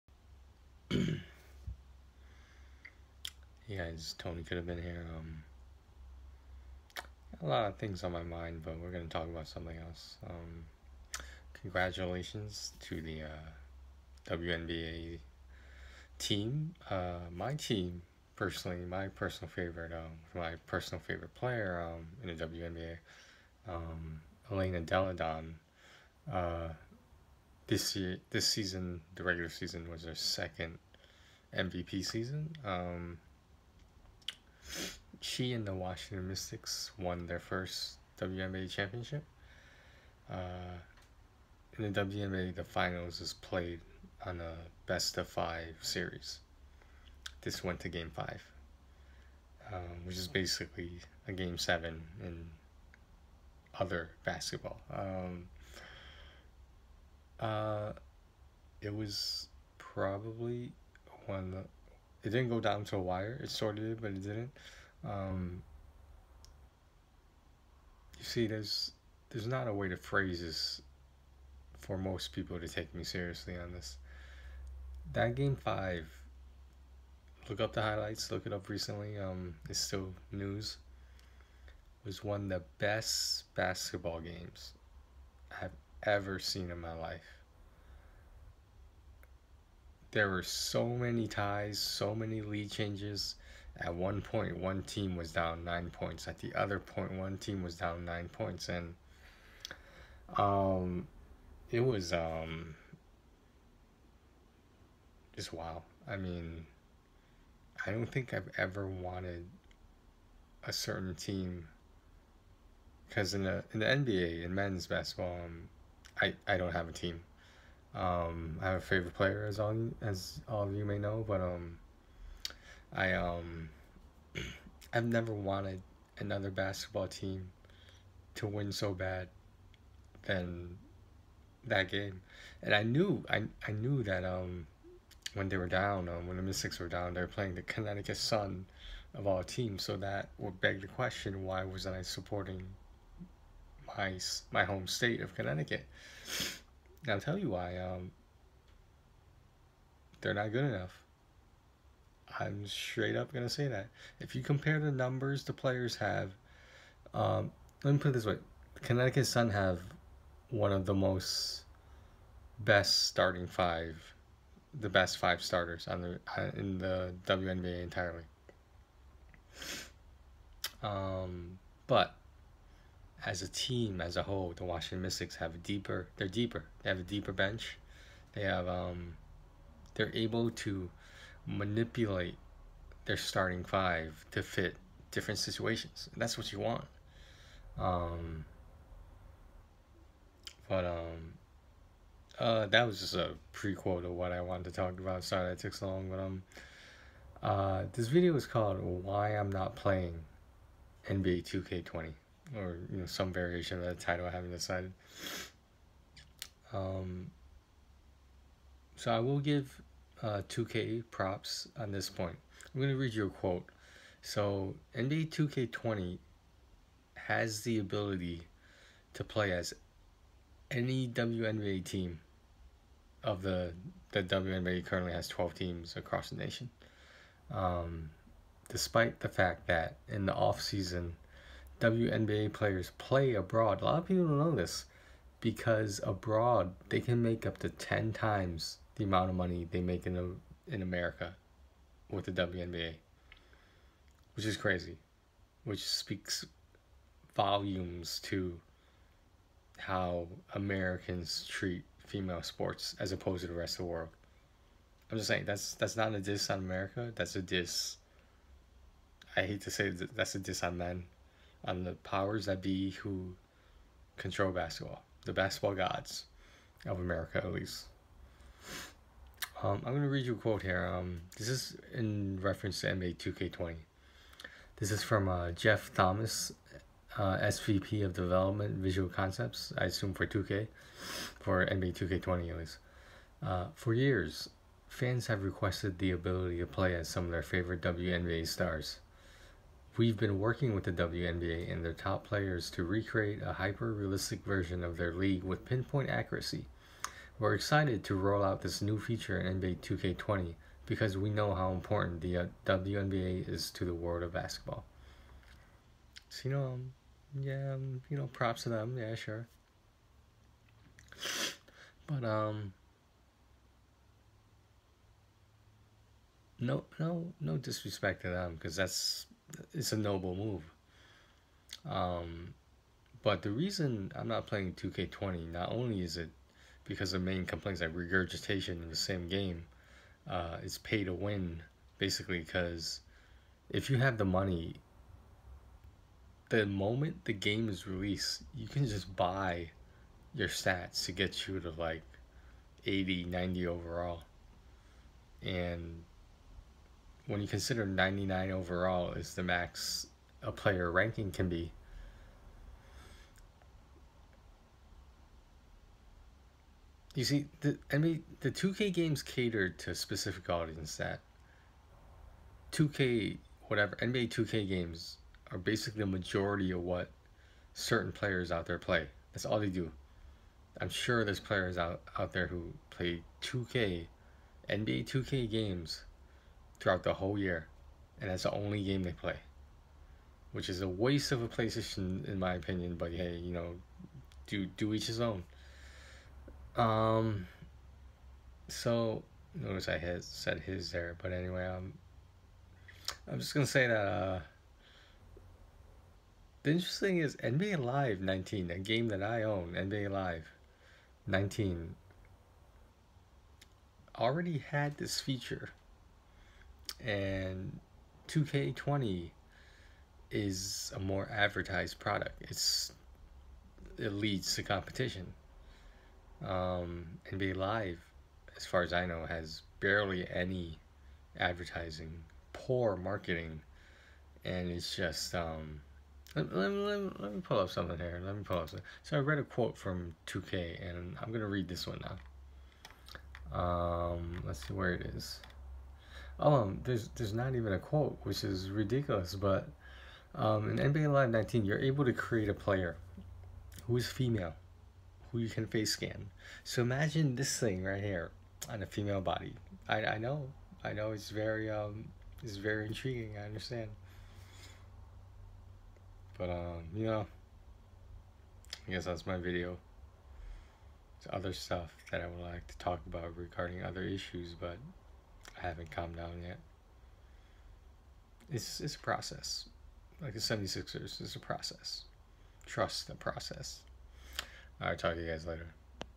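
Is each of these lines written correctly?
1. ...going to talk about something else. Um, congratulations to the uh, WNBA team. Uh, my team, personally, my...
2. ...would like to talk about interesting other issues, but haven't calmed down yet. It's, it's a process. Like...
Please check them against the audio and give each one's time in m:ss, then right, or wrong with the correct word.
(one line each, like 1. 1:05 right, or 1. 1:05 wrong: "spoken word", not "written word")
1. 0:08 right
2. 7:42 wrong: "regarding", not "interesting".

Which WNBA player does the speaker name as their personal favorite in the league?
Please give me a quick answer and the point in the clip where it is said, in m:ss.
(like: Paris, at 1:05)
Elena Delle Donne, at 0:24.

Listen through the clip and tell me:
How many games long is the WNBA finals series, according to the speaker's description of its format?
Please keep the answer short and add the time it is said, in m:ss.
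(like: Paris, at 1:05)
5, at 0:44.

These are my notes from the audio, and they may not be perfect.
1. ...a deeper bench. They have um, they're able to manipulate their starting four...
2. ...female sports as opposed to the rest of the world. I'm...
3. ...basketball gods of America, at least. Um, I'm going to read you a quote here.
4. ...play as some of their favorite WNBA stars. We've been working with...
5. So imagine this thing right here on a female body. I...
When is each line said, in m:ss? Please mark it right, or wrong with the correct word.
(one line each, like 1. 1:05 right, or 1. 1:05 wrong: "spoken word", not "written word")
1. 2:56 wrong: "five", not "four"
2. 4:12 right
3. 4:25 right
4. 4:46 right
5. 7:26 right.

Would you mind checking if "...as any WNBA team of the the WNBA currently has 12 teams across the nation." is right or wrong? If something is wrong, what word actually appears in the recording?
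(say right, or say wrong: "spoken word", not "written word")
right.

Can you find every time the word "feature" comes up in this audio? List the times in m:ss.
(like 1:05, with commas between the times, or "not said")
4:58, 6:45.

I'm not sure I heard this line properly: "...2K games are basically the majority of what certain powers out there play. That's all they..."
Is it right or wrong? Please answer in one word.
wrong.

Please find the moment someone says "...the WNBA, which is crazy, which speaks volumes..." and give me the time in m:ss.
4:02.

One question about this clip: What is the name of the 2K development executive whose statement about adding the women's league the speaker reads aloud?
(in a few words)
Jeff Thomas.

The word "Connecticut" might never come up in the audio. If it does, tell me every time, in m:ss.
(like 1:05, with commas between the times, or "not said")
2:17, 2:25, 2:38.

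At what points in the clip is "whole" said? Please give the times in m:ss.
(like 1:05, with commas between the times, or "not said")
2:54, 6:17.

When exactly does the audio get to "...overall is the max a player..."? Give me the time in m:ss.
5:48.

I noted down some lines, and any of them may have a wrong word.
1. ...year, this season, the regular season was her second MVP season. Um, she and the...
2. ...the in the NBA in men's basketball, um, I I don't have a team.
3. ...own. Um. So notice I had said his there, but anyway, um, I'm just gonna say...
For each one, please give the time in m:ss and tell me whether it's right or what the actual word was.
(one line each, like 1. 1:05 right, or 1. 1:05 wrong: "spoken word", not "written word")
1. 0:27 right
2. 1:53 right
3. 6:25 right.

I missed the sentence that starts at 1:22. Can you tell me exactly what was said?
Was one of the best basketball games I've ever seen in my life.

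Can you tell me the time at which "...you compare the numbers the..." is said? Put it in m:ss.
2:34.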